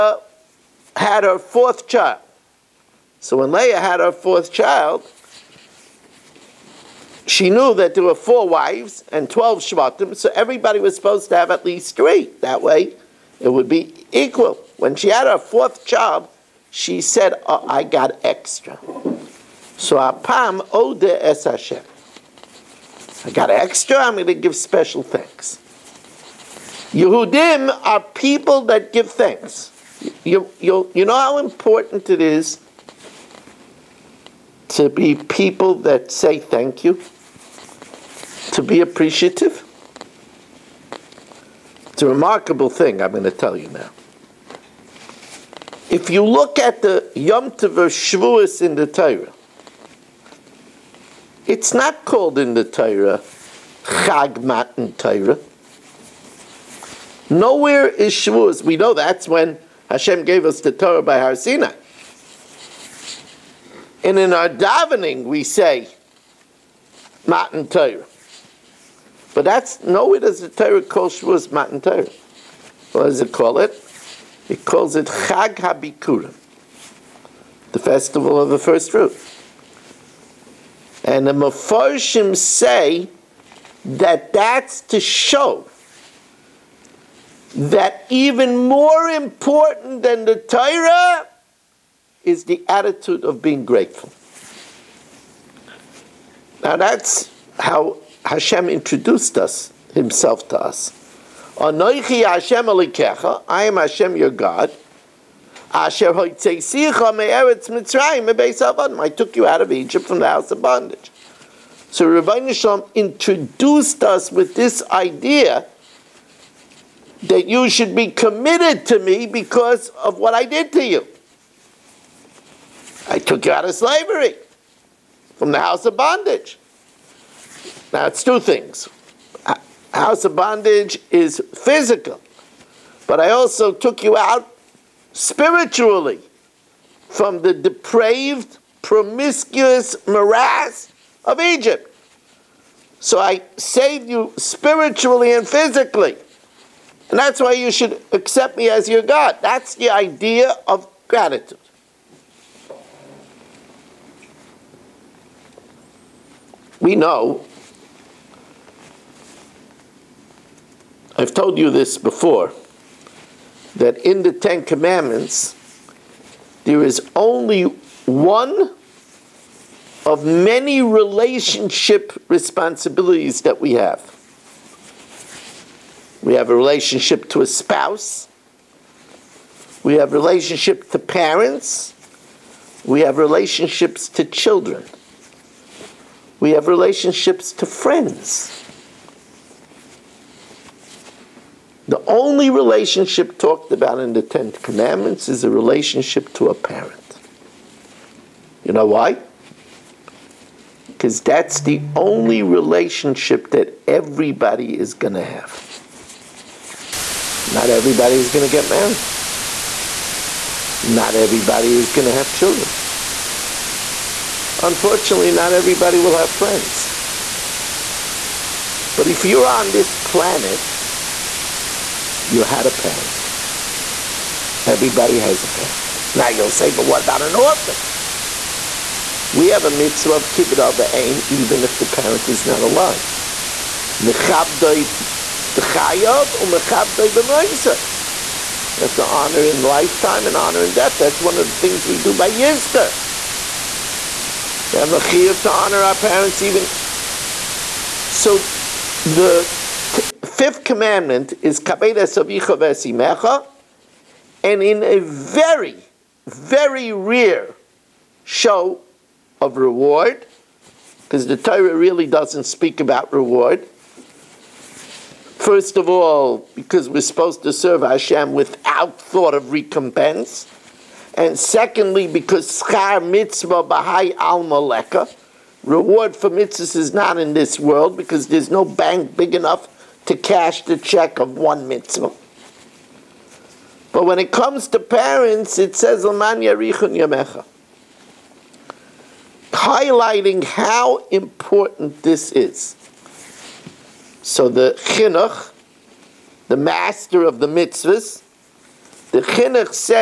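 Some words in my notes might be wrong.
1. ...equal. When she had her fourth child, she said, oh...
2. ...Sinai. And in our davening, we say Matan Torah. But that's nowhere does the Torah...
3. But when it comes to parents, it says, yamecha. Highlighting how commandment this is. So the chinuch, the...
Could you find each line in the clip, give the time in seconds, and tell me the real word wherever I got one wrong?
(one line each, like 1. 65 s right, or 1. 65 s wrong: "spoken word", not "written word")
1. 14 s right
2. 61 s right
3. 283 s wrong: "important", not "commandment".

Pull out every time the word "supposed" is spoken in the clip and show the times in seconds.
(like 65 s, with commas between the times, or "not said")
10 s, 267 s.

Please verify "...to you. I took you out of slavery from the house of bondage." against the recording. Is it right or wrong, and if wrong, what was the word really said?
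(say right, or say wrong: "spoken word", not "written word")
right.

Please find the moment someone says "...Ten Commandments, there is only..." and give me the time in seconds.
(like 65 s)
164 s.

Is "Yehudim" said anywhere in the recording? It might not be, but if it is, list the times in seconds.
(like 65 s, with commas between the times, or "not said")
26 s.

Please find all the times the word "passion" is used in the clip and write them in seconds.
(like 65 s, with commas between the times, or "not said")
not said.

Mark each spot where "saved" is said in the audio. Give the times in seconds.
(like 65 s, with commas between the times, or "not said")
143 s.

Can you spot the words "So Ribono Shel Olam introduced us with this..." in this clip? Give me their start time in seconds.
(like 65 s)
111 s.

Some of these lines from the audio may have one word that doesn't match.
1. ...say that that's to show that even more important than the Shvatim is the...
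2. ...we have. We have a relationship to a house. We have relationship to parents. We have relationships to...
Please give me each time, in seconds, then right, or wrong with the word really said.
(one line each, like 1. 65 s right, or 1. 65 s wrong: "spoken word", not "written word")
1. 82 s wrong: "Torah", not "Shvatim"
2. 173 s wrong: "spouse", not "house".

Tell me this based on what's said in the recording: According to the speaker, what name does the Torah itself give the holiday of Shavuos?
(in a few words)
Chag Habikurim.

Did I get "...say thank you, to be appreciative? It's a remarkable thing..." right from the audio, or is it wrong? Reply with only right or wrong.
right.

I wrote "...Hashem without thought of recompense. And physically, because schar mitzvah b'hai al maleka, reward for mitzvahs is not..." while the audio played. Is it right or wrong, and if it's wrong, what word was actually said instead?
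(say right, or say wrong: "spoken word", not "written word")
wrong: "secondly", not "physically".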